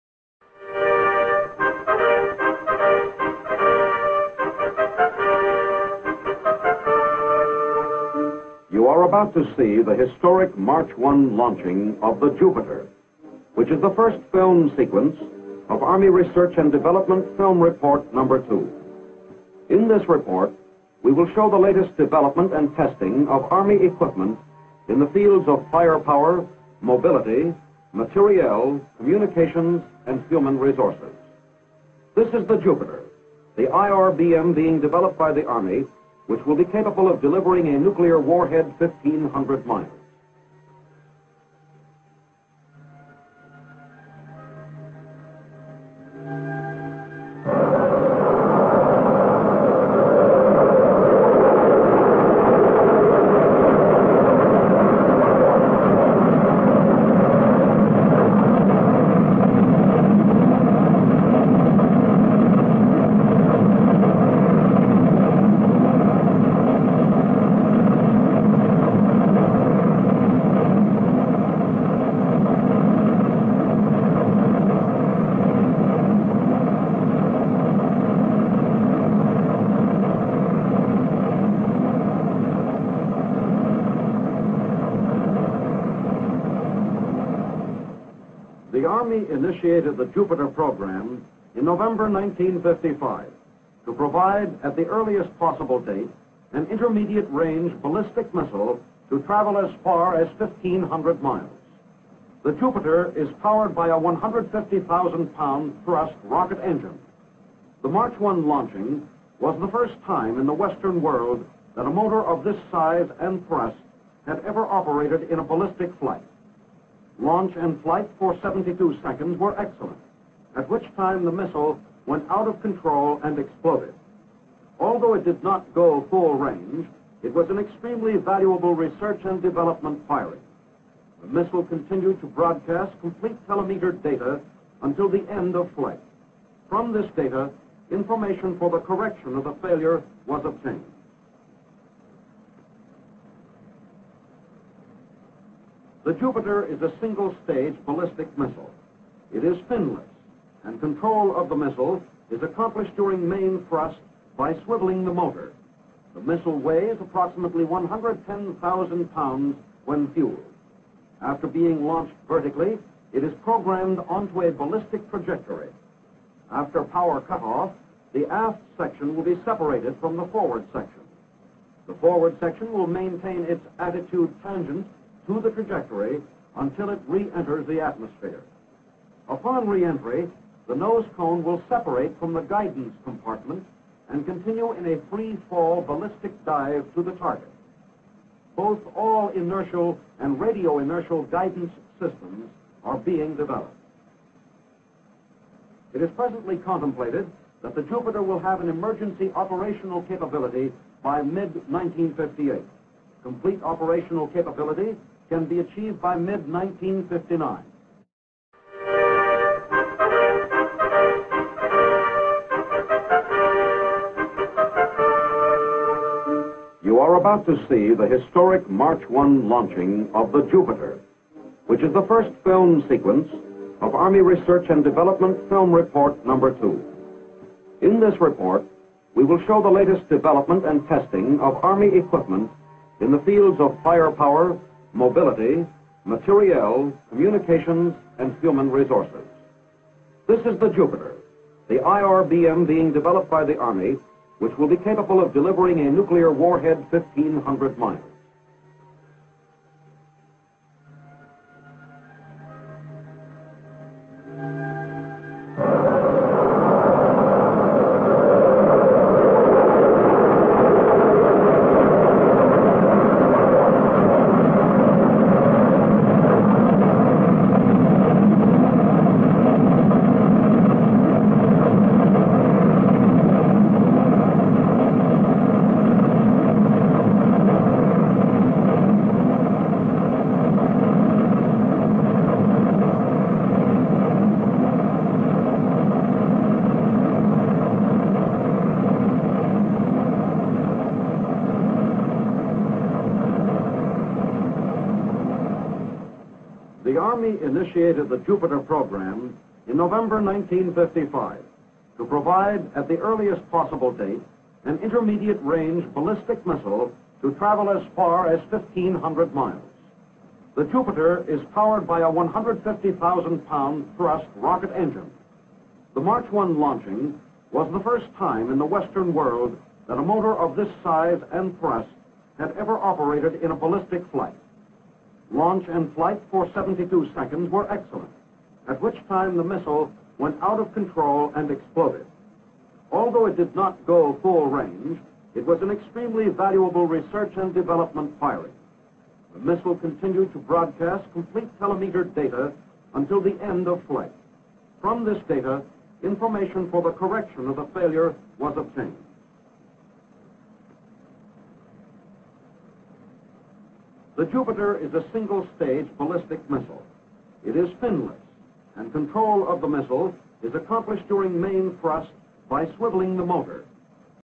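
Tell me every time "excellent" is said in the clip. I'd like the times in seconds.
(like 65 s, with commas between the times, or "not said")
119 s, 327 s.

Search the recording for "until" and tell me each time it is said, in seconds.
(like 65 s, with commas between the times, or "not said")
134 s, 176 s, 342 s.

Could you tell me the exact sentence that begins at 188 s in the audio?
Both all inertial and radio inertial guidance systems are being developed.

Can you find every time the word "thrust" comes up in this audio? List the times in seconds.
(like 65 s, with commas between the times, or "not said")
105 s, 113 s, 153 s, 313 s, 321 s, 361 s.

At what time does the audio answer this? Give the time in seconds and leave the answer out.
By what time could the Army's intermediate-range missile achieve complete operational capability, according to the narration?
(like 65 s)
206 s.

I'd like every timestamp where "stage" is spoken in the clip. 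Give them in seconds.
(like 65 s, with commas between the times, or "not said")
146 s, 355 s.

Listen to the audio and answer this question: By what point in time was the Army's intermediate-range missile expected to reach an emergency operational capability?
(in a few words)
mid-1958.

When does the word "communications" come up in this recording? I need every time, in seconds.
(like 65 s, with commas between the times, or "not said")
28 s, 237 s.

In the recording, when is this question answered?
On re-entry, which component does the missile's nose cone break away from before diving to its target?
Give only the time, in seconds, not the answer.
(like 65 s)
182 s.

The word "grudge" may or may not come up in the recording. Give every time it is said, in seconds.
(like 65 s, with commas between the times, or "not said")
not said.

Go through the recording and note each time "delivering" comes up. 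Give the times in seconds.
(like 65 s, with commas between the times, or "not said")
37 s, 245 s.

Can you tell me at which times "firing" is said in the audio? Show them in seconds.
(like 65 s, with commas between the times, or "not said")
130 s, 338 s.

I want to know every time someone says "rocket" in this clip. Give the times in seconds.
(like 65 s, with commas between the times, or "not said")
106 s, 314 s.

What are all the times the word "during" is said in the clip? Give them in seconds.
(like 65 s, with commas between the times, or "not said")
152 s, 361 s.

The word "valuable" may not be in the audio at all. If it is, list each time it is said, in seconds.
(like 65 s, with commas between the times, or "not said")
128 s, 336 s.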